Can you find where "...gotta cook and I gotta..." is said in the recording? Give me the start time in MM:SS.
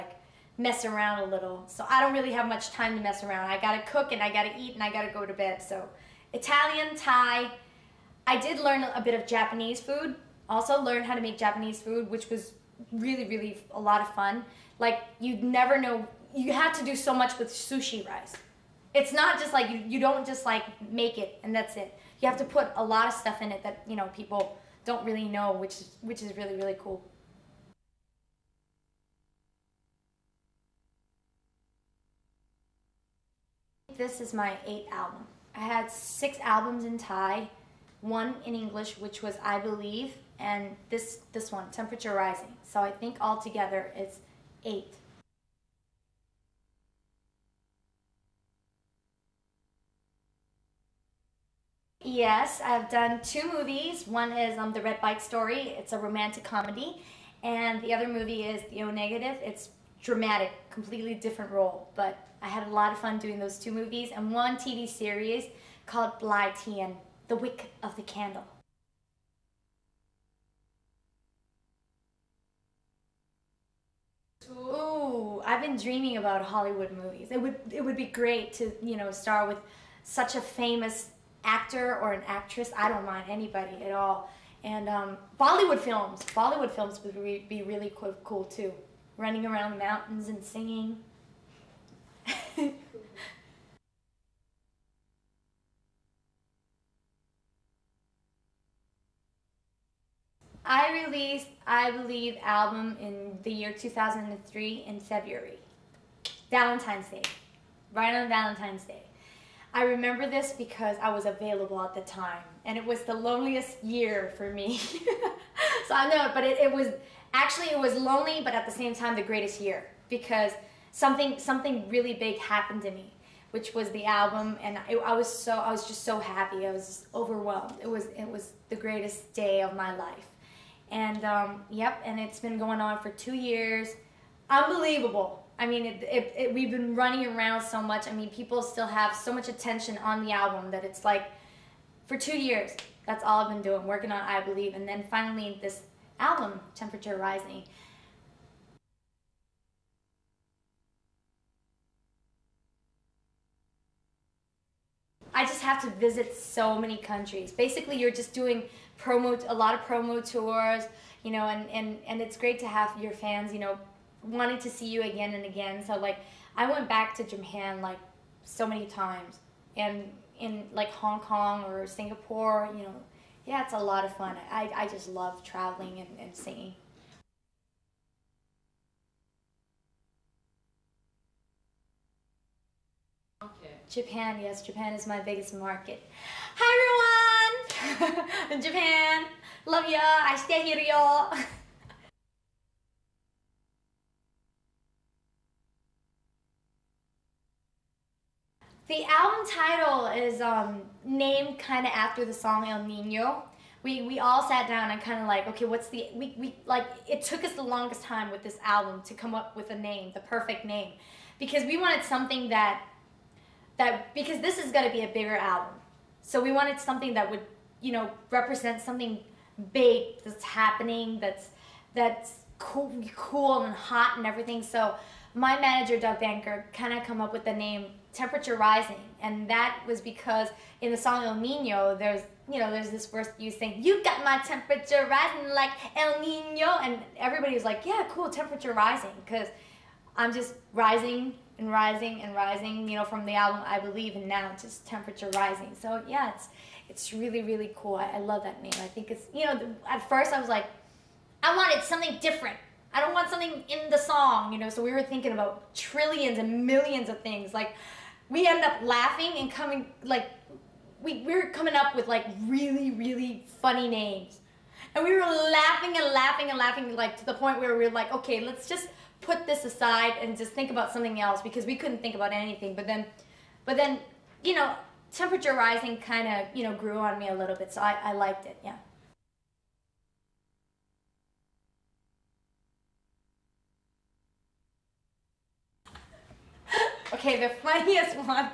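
00:03.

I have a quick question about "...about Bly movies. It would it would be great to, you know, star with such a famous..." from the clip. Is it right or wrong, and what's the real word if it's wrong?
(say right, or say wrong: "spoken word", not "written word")
wrong: "Hollywood", not "Bly".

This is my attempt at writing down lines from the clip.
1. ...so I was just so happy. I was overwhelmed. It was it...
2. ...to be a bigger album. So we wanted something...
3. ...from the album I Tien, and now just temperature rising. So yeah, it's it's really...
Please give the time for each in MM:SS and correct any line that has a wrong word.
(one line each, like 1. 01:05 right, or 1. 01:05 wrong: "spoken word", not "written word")
1. 02:05 right
2. 03:34 right
3. 04:03 wrong: "Believe", not "Tien".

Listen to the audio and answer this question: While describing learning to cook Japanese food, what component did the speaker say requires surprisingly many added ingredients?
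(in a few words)
sushi rice.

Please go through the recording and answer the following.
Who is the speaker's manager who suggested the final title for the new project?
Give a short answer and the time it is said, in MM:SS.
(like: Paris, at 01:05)
Doug Banker, at 03:45.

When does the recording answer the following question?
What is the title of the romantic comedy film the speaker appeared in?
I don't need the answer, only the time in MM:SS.
00:54.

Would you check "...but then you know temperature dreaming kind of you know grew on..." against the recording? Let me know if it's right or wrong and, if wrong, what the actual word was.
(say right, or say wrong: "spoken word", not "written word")
wrong: "rising", not "dreaming".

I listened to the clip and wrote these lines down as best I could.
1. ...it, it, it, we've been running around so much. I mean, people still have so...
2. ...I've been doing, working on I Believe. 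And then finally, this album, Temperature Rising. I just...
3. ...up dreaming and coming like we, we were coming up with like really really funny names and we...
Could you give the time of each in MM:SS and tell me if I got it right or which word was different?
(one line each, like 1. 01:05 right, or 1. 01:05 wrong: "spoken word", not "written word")
1. 02:15 right
2. 02:23 right
3. 04:18 wrong: "laughing", not "dreaming".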